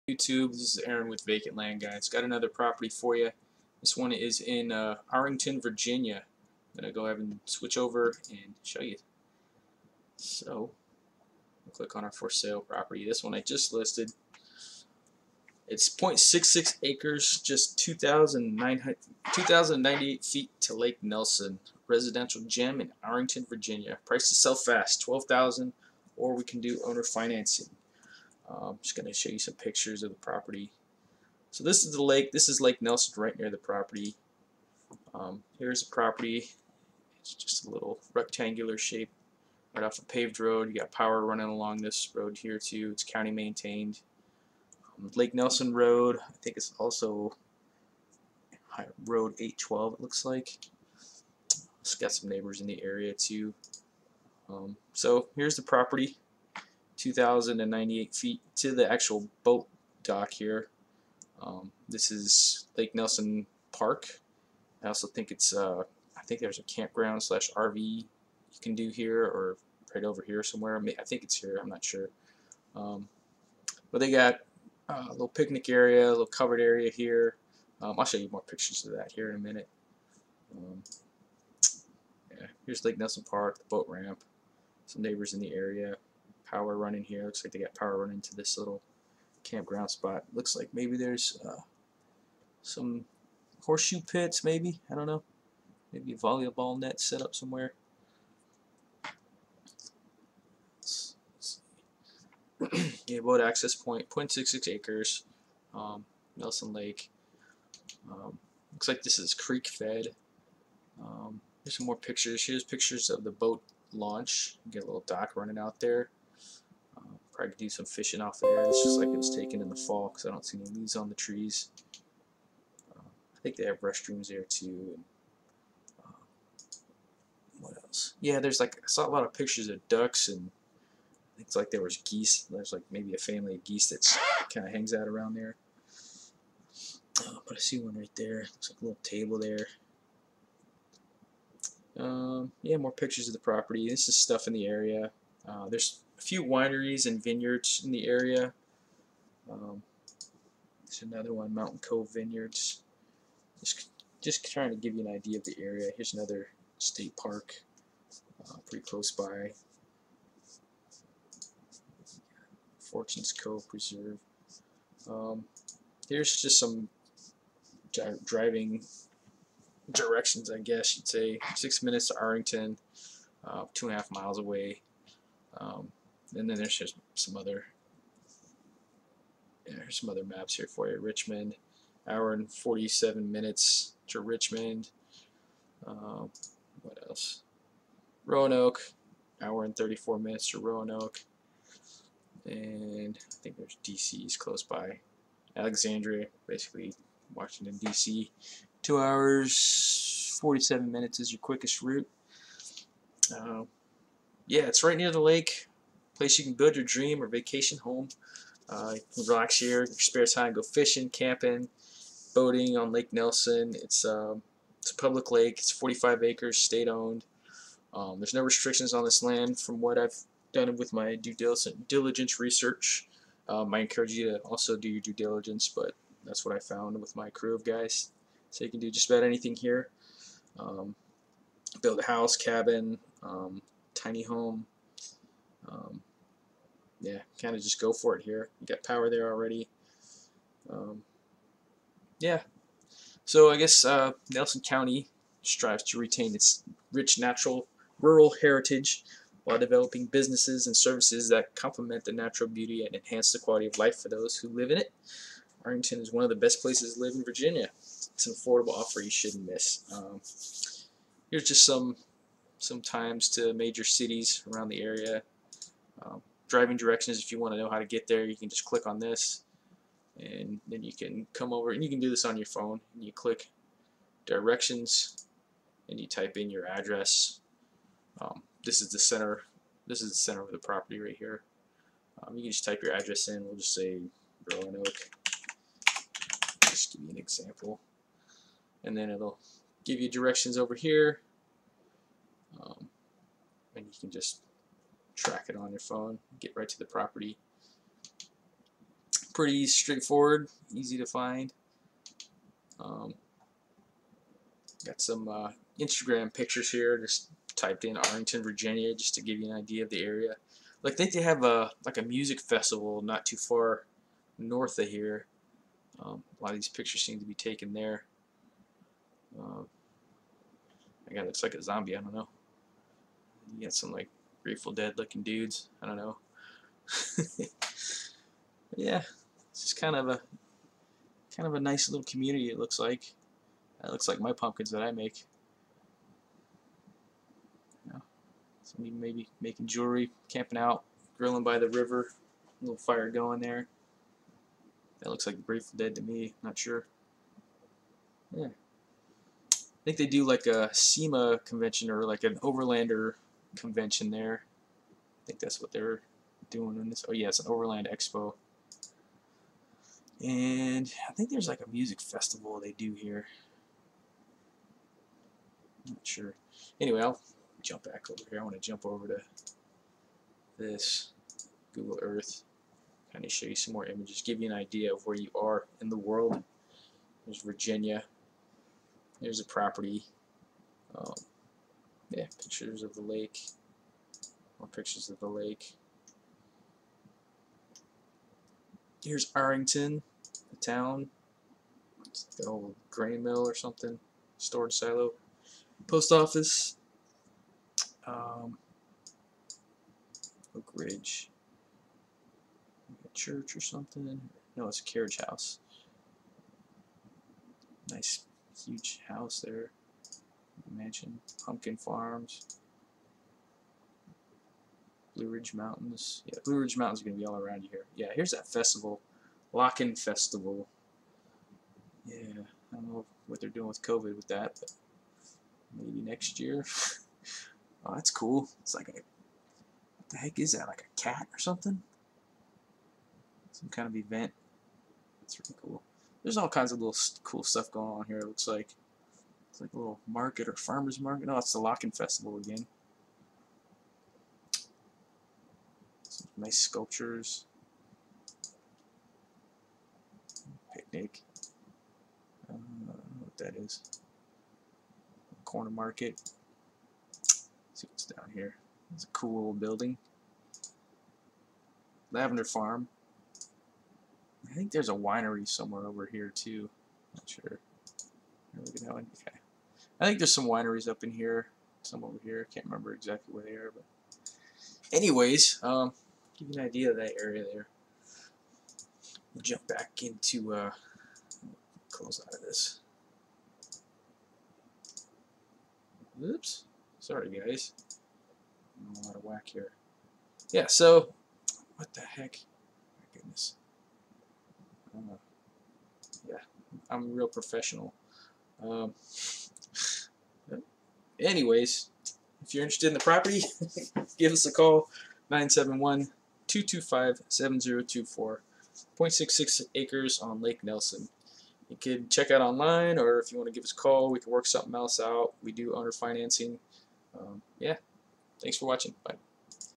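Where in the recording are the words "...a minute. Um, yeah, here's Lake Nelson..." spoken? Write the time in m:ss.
1:19.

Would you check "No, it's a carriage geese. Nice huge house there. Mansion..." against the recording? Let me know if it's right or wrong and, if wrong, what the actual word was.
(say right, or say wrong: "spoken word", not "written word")
wrong: "house", not "geese".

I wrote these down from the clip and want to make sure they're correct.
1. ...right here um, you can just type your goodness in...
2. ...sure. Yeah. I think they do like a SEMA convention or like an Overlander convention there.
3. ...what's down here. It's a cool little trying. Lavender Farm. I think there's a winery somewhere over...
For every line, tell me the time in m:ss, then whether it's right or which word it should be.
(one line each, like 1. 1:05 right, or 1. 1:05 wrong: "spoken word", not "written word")
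1. 4:40 wrong: "address", not "goodness"
2. 5:46 right
3. 7:37 wrong: "building", not "trying".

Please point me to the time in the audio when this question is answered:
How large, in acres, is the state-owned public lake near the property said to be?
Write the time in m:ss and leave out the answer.
3:35.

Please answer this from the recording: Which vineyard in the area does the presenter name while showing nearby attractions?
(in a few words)
Mountain Cove Vineyards.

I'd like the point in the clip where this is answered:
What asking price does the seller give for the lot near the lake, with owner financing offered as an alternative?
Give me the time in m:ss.
0:25.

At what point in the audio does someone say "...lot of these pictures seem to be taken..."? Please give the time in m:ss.
5:16.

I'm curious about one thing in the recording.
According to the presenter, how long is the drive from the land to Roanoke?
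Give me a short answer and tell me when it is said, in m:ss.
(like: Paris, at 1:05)
1 hour 34 minutes, at 3:09.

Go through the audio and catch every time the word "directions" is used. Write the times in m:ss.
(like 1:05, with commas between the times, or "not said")
2:49, 4:26, 4:34, 4:50.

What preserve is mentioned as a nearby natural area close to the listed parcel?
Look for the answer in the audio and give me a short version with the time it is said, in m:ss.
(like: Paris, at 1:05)
Fortune's Cove Preserve, at 2:42.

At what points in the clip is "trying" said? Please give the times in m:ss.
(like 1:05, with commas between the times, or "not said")
2:34.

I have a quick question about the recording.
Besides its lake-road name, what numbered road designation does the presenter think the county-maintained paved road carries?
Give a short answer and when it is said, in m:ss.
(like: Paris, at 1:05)
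Road 812, at 0:49.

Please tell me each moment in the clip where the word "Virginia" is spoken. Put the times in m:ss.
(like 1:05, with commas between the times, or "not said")
0:05, 0:23, 4:17, 5:08, 6:17.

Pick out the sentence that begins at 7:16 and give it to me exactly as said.
There's all kinds of little cool stuff going on here, it looks like like a little market or farmer's market.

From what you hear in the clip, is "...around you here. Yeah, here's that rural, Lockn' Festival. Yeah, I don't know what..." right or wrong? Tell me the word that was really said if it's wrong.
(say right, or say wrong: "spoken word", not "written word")
wrong: "festival", not "rural".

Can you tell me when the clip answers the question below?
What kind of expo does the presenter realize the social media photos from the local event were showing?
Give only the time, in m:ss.
5:57.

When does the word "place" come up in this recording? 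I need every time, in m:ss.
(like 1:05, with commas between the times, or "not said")
3:26, 4:16.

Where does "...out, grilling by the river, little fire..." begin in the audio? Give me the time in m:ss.
5:40.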